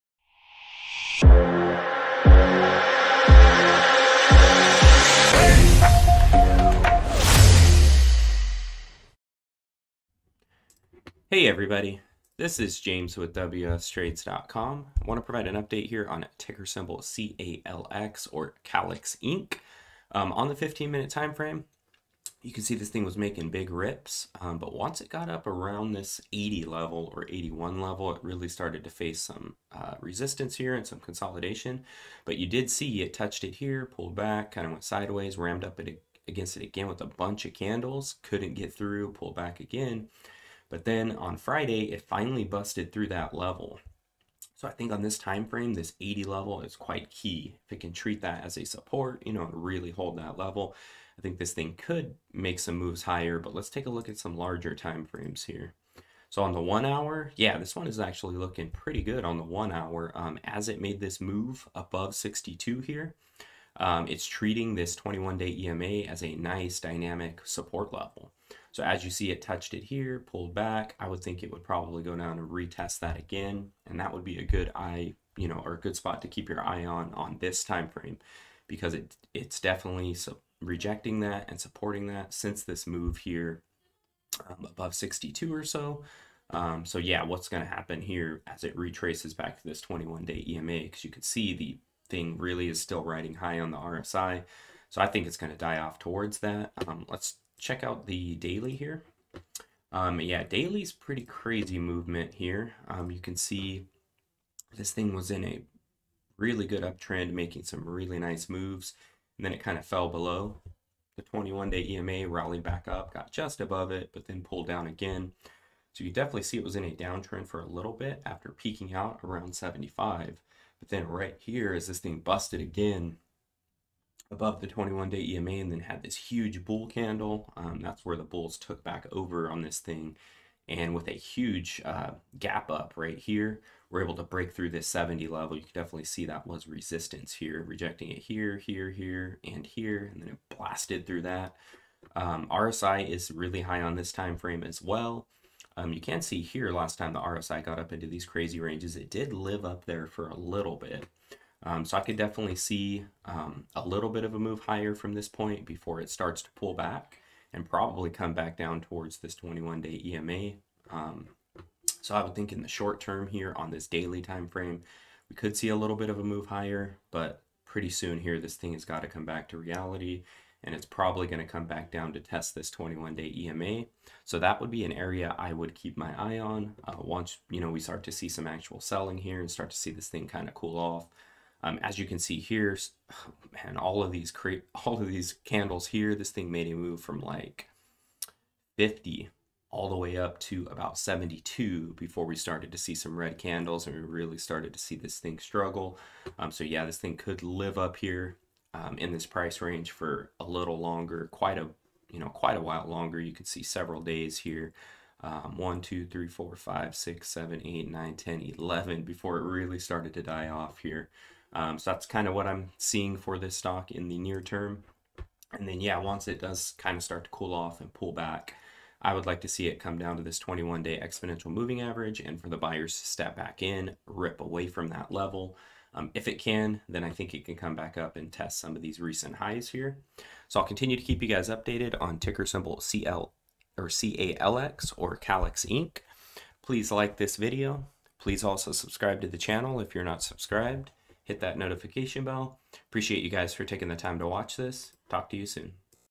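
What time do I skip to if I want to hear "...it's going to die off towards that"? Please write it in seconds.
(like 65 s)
95 s.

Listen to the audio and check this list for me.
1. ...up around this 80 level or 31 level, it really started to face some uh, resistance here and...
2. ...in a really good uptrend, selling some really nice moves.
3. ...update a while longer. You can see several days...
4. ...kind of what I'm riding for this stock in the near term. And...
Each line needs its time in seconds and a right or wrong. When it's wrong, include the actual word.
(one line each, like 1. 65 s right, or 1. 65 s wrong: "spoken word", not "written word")
1. 25 s wrong: "81", not "31"
2. 105 s wrong: "making", not "selling"
3. 202 s wrong: "quite", not "update"
4. 212 s wrong: "seeing", not "riding".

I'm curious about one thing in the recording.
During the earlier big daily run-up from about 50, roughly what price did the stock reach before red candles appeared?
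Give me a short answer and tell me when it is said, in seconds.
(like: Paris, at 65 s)
72, at 190 s.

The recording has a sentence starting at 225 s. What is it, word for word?
Um, if it can, then I think it can come back up and test some of these recent highs here.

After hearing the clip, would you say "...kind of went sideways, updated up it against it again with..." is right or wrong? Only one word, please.
wrong.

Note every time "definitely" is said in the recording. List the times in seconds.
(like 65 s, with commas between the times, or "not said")
79 s, 116 s, 135 s, 152 s.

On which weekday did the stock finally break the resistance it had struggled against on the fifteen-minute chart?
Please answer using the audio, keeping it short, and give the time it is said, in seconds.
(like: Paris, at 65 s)
Friday, at 41 s.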